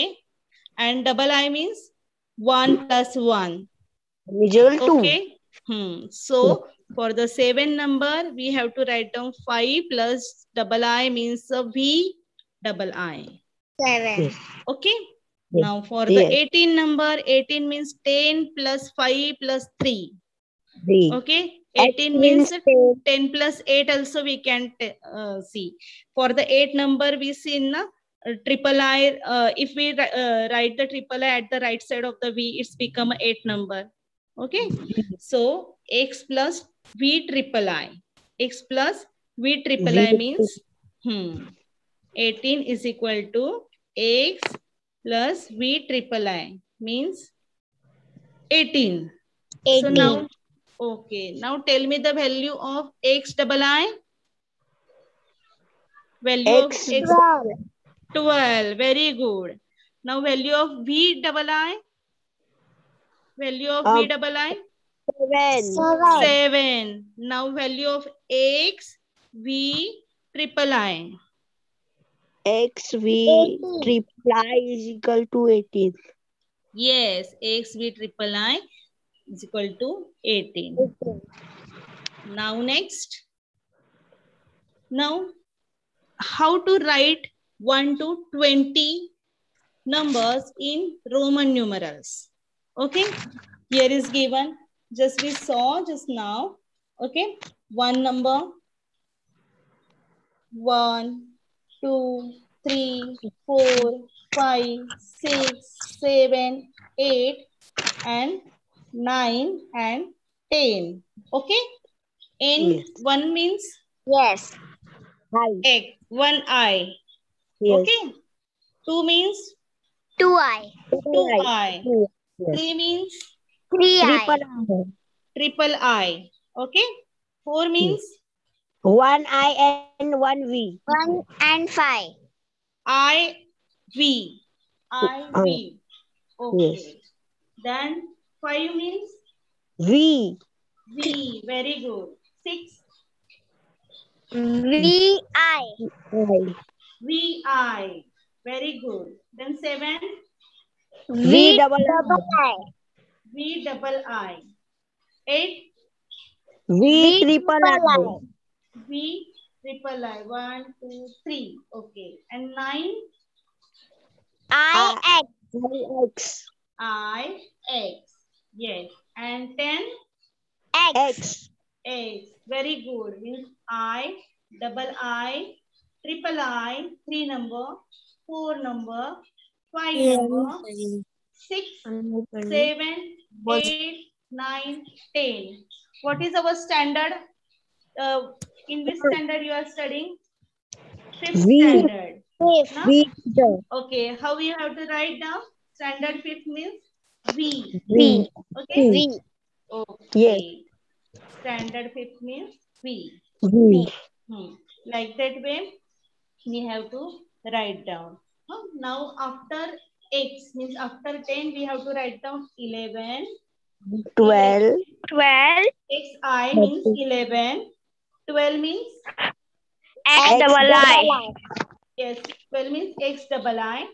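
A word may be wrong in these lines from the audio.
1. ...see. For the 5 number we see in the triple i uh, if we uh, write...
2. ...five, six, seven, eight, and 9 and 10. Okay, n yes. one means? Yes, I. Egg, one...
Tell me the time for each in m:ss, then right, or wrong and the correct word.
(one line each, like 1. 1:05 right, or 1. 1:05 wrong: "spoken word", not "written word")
1. 0:25 wrong: "8", not "5"
2. 1:44 right.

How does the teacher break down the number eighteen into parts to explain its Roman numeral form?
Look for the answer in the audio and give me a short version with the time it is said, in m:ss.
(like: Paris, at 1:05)
10 plus 5 plus 3, at 0:18.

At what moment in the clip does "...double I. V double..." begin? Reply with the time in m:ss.
2:31.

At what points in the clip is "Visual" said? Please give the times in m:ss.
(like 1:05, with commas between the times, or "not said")
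0:04.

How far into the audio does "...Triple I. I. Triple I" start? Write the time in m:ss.
2:04.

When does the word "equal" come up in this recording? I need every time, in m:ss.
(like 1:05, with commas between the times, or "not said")
0:42, 1:14, 1:19.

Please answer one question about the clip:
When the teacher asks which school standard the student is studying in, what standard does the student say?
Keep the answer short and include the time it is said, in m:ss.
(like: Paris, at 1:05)
Fifth standard, at 3:11.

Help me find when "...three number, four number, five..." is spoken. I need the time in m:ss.
2:57.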